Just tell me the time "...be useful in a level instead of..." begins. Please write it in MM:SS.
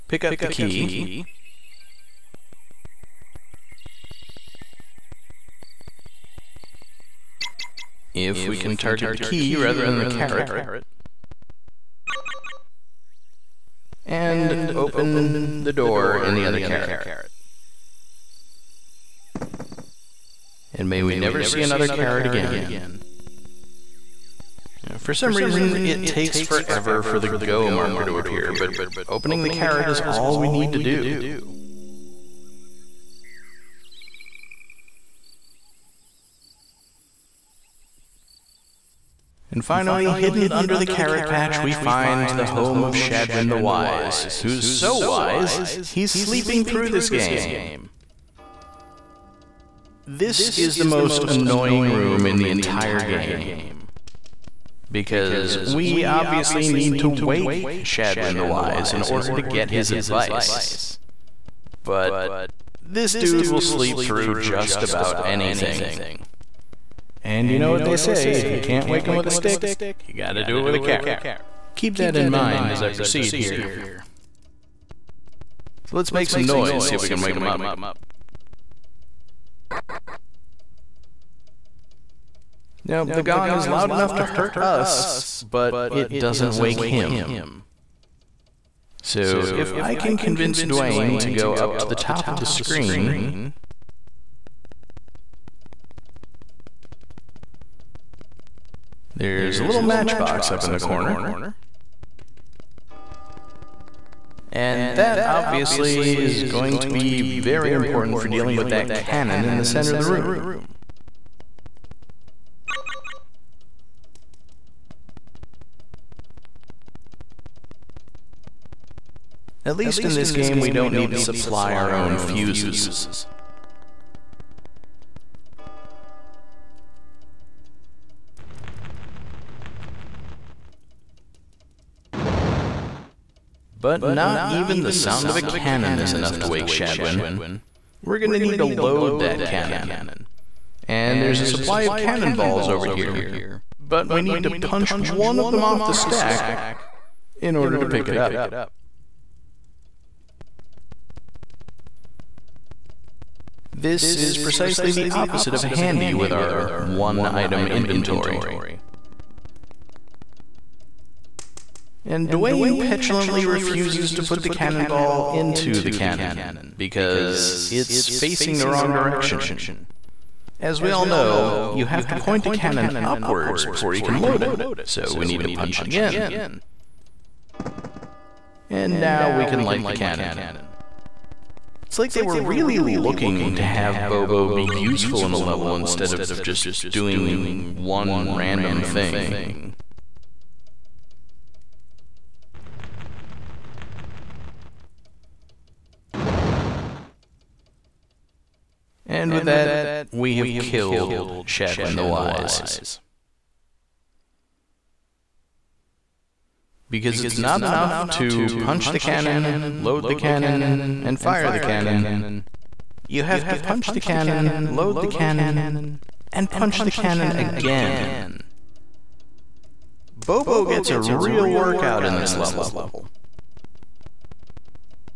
03:04.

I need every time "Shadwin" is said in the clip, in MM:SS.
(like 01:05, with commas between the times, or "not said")
00:42, 00:57, 02:16, 03:21.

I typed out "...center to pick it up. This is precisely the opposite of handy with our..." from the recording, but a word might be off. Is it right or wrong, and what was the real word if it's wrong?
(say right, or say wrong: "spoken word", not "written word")
wrong: "order", not "center".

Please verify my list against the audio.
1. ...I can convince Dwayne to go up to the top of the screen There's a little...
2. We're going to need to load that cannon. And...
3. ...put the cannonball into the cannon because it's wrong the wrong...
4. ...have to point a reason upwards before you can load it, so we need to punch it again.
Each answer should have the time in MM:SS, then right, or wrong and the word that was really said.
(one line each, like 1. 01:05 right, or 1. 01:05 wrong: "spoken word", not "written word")
1. 01:29 right
2. 02:18 right
3. 02:44 wrong: "facing", not "wrong"
4. 02:51 wrong: "cannon", not "reason".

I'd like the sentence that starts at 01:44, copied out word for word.
And that obviously is going to be very important for dealing with that cannon in the center of the room.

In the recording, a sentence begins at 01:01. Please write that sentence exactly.
But this dude will sleep through just about anything.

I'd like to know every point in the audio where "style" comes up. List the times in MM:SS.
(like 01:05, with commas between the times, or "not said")
not said.